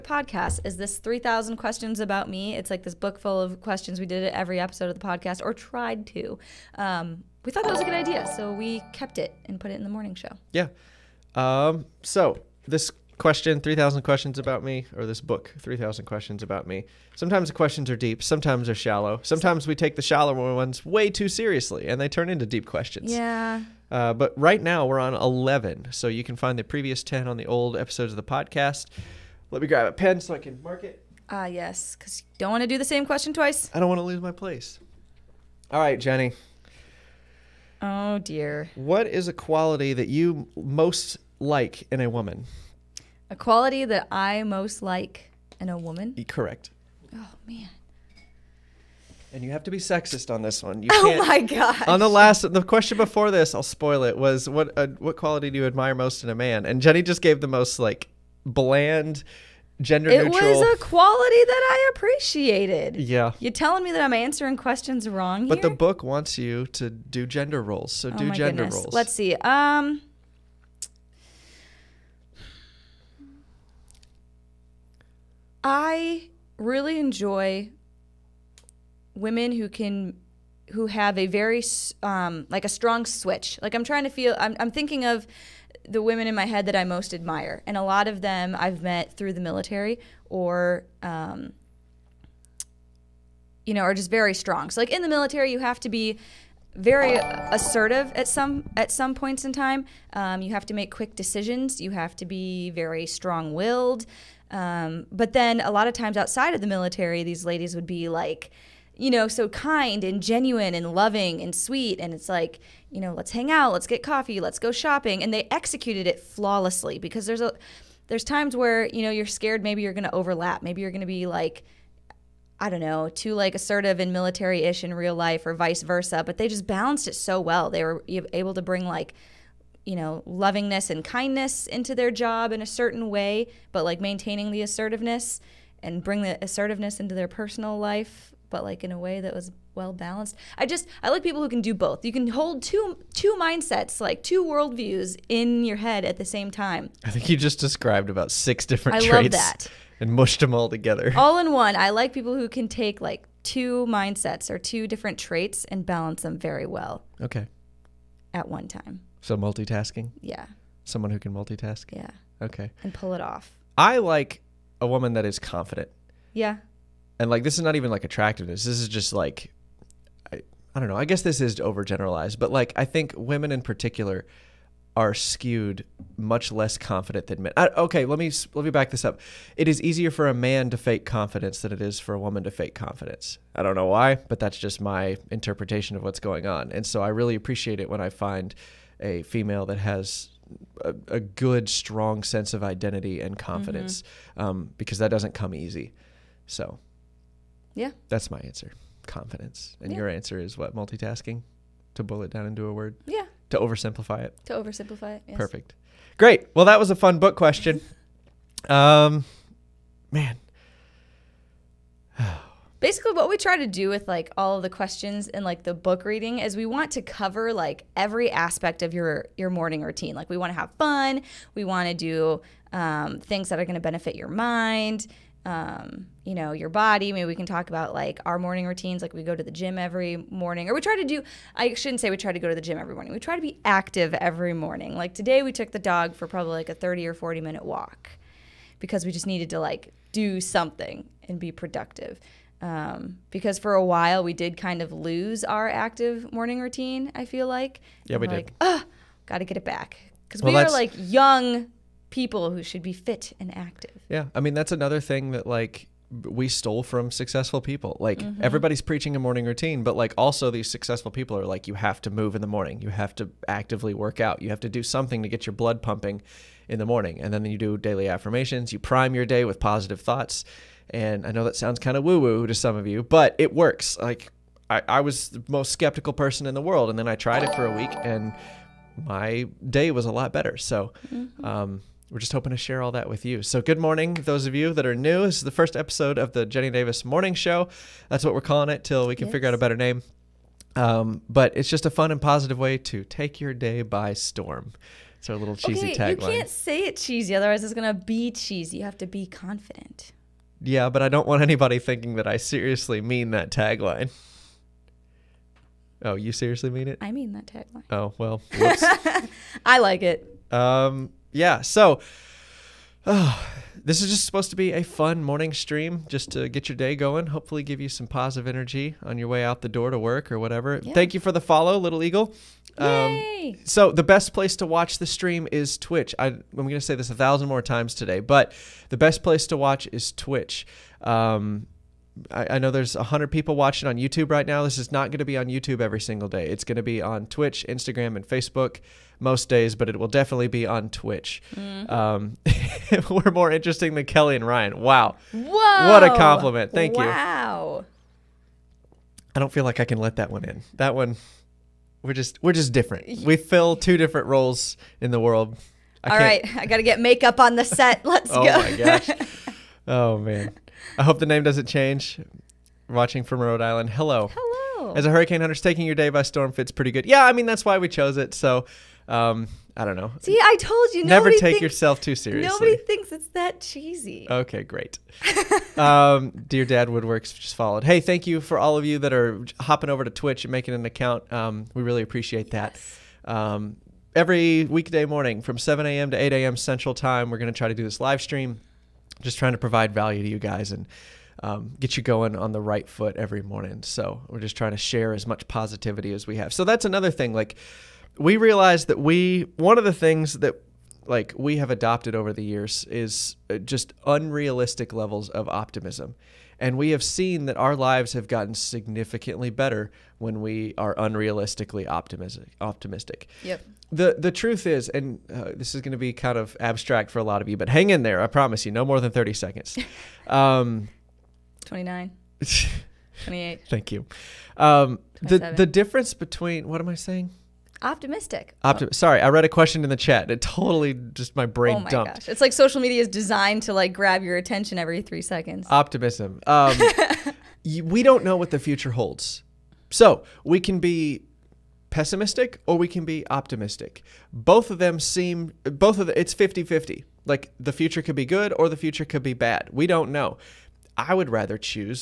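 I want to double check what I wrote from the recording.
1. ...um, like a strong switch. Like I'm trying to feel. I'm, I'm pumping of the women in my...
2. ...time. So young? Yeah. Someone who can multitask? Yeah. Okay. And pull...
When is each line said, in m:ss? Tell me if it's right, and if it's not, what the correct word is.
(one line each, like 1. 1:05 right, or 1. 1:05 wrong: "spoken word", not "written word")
1. 1:22 wrong: "thinking", not "pumping"
2. 2:38 wrong: "multitasking", not "young".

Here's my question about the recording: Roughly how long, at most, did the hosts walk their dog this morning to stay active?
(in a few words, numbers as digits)
40 minutes.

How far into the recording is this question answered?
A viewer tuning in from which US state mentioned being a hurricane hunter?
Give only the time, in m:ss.
6:03.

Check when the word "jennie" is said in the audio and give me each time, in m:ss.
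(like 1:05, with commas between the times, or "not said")
0:36, 0:56, 4:46.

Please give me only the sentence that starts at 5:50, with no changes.
That one, we're just we're just different.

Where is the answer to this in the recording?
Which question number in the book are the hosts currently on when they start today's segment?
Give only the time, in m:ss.
0:25.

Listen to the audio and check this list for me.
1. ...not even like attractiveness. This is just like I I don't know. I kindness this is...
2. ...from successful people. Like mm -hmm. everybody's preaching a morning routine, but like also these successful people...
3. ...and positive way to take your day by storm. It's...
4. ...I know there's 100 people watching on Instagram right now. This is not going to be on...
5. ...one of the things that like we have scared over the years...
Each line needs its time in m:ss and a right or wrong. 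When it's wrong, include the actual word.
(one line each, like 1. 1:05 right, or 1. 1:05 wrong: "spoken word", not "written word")
1. 2:47 wrong: "guess", not "kindness"
2. 4:16 right
3. 4:52 right
4. 5:32 wrong: "YouTube", not "Instagram"
5. 6:39 wrong: "adopted", not "scared".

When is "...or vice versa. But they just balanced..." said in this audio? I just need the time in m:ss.
2:05.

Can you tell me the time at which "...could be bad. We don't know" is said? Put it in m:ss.
7:29.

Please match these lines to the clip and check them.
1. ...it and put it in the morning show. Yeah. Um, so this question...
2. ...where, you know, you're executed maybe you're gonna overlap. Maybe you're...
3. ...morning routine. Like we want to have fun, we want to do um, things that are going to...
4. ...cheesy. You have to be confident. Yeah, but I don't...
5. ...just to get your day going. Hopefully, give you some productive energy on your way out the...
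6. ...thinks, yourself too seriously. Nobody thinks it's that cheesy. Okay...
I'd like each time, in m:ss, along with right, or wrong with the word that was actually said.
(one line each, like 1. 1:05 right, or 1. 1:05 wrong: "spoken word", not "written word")
1. 0:09 right
2. 1:58 wrong: "scared", not "executed"
3. 3:39 right
4. 4:58 right
5. 5:16 wrong: "positive", not "productive"
6. 6:11 right.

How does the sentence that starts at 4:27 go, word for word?
And then you do daily affirmations.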